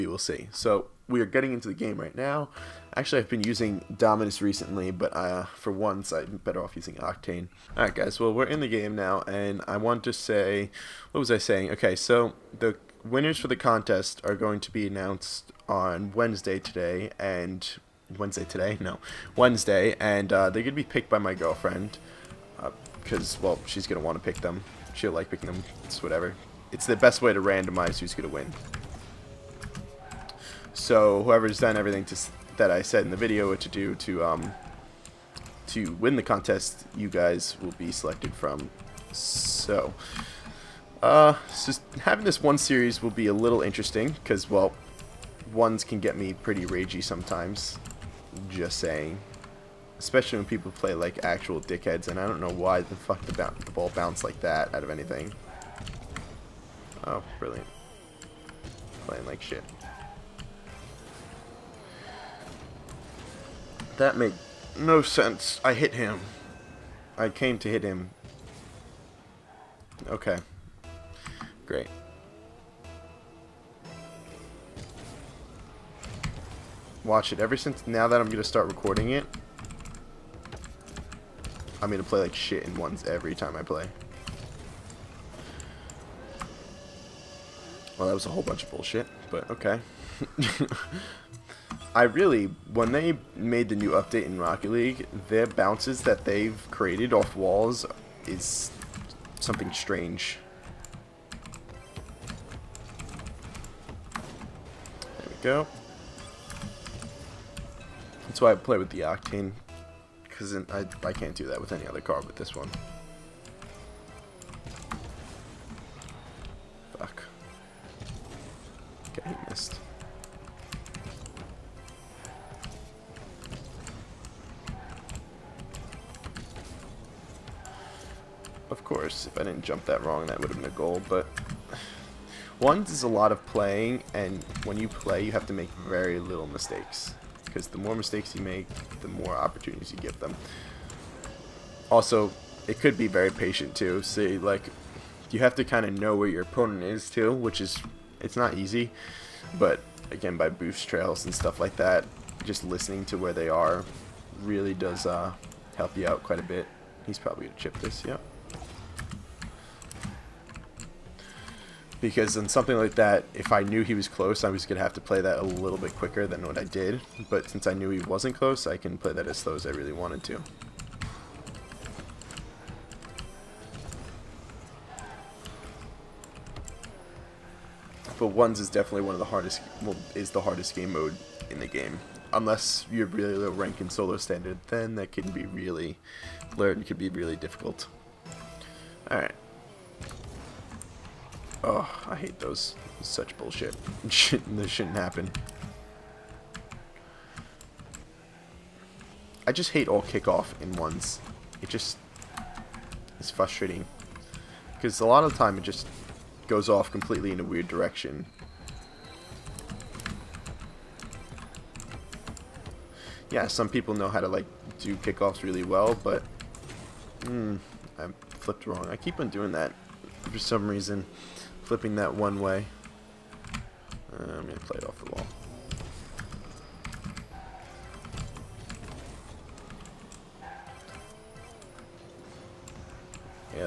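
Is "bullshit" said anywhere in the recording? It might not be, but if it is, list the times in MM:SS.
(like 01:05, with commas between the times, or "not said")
01:28, 03:13.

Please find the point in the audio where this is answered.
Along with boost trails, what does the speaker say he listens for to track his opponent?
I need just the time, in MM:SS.
02:33.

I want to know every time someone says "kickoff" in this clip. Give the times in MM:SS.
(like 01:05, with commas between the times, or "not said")
03:20, 03:34.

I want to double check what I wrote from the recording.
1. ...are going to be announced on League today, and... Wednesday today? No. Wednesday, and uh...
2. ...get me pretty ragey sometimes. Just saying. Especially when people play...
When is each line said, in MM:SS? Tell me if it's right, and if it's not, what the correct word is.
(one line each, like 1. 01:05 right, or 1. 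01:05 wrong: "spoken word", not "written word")
1. 00:14 wrong: "Wednesday", not "League"
2. 00:46 right.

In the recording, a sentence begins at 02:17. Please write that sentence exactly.
Because the more mistakes you make, the more opportunities you get them.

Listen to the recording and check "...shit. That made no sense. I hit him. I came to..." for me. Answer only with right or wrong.
right.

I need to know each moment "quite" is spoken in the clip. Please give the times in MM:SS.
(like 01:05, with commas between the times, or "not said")
02:36.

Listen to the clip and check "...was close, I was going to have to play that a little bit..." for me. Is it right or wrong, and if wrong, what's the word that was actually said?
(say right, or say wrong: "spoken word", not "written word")
right.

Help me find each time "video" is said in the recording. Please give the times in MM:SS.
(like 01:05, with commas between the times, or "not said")
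00:33.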